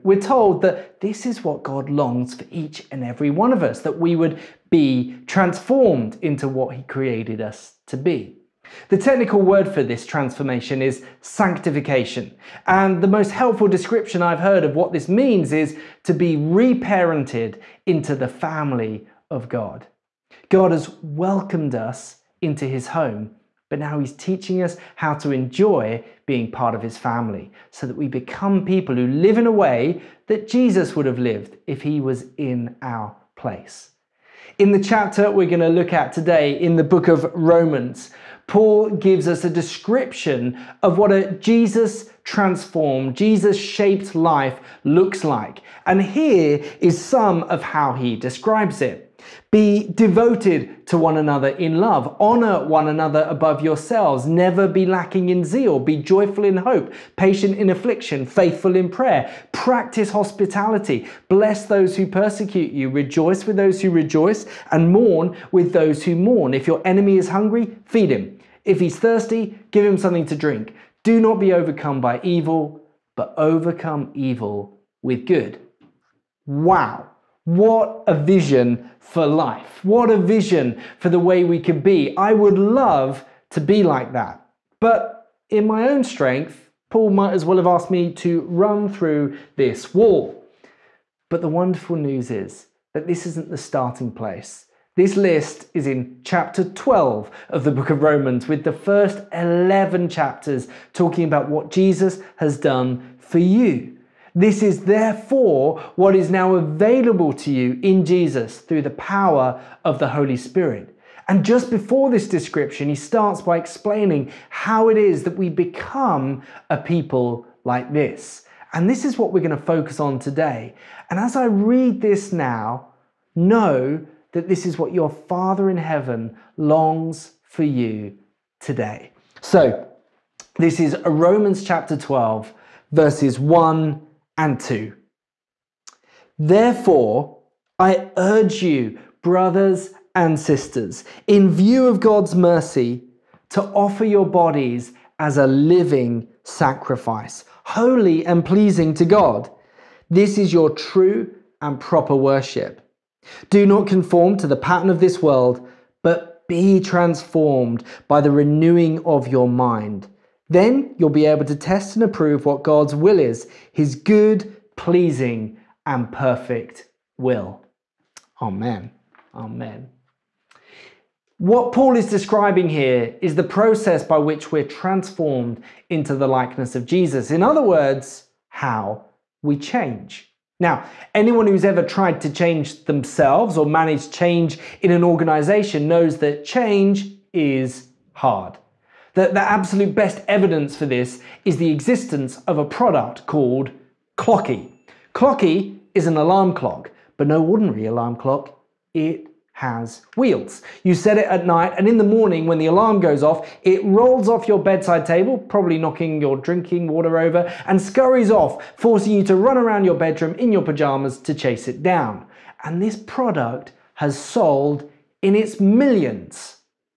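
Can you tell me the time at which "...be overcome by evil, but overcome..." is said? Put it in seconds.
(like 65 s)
71 s.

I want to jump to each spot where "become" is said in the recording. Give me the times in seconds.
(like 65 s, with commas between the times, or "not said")
28 s, 115 s.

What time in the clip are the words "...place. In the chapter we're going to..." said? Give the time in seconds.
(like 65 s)
33 s.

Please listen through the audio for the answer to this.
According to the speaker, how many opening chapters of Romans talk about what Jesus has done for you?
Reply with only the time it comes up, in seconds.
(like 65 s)
98 s.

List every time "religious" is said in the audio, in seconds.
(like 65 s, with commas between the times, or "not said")
not said.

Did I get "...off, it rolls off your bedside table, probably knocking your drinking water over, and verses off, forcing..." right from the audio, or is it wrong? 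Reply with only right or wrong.
wrong.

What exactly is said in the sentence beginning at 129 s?
So, this is Romans chapter 12, verses 1 and 2.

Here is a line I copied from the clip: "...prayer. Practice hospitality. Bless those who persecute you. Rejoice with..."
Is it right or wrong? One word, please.
right.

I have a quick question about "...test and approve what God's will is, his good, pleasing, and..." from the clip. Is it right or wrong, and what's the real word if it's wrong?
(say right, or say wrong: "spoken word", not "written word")
right.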